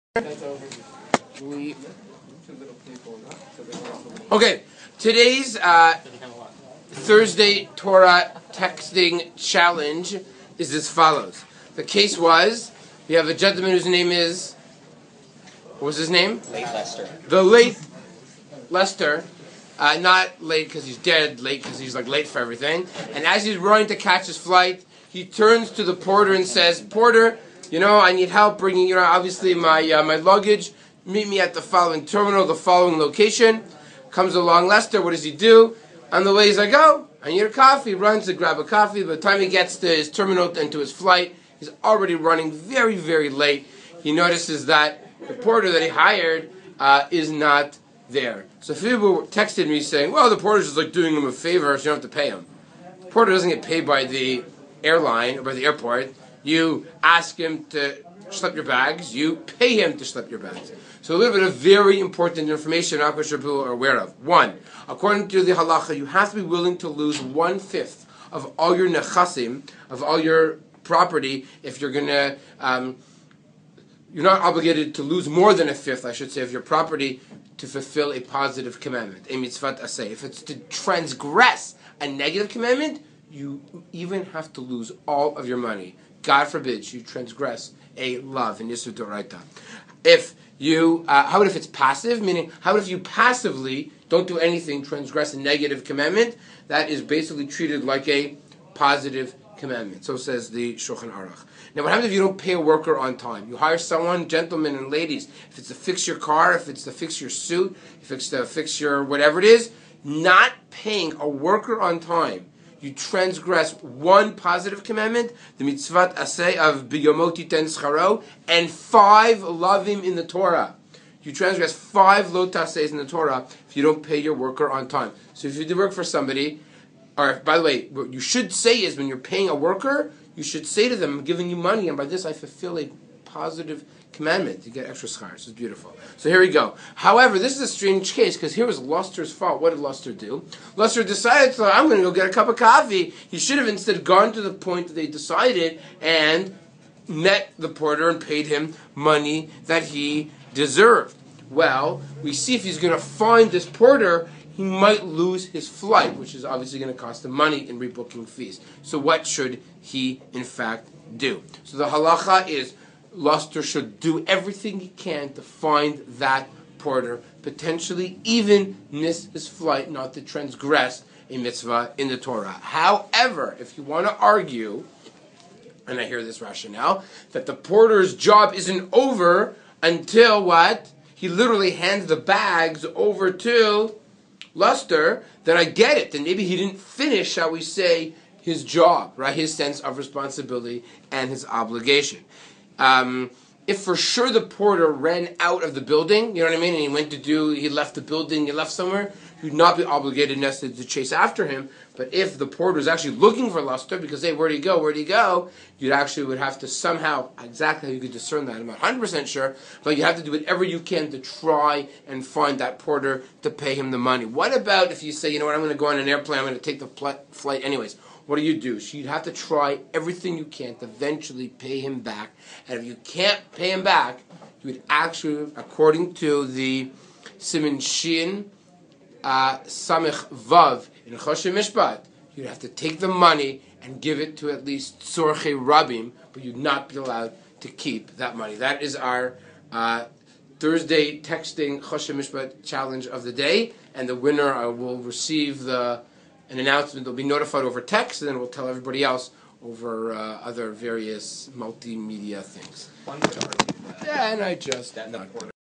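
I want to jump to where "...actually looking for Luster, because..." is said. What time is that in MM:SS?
03:22.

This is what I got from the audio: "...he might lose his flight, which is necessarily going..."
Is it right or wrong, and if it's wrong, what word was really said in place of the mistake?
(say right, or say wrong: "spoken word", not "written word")
wrong: "obviously", not "necessarily".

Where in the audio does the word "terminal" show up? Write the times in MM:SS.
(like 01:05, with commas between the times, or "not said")
00:32, 00:40.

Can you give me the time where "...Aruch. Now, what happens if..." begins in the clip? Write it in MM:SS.
01:41.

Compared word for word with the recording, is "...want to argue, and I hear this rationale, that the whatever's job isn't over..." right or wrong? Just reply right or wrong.
wrong.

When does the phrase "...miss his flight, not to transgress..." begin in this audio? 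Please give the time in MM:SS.
02:48.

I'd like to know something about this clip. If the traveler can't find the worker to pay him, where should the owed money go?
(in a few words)
Tzorche Rabim.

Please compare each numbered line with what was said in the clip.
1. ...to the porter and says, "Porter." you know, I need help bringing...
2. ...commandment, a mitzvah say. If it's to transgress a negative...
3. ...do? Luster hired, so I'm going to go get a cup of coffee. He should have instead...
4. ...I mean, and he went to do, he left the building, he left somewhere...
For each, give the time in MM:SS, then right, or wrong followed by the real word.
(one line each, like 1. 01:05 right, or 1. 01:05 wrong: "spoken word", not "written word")
1. 00:25 right
2. 01:18 right
3. 02:20 wrong: "decided", not "hired"
4. 03:16 right.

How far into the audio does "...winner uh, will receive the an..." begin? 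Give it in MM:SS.
04:04.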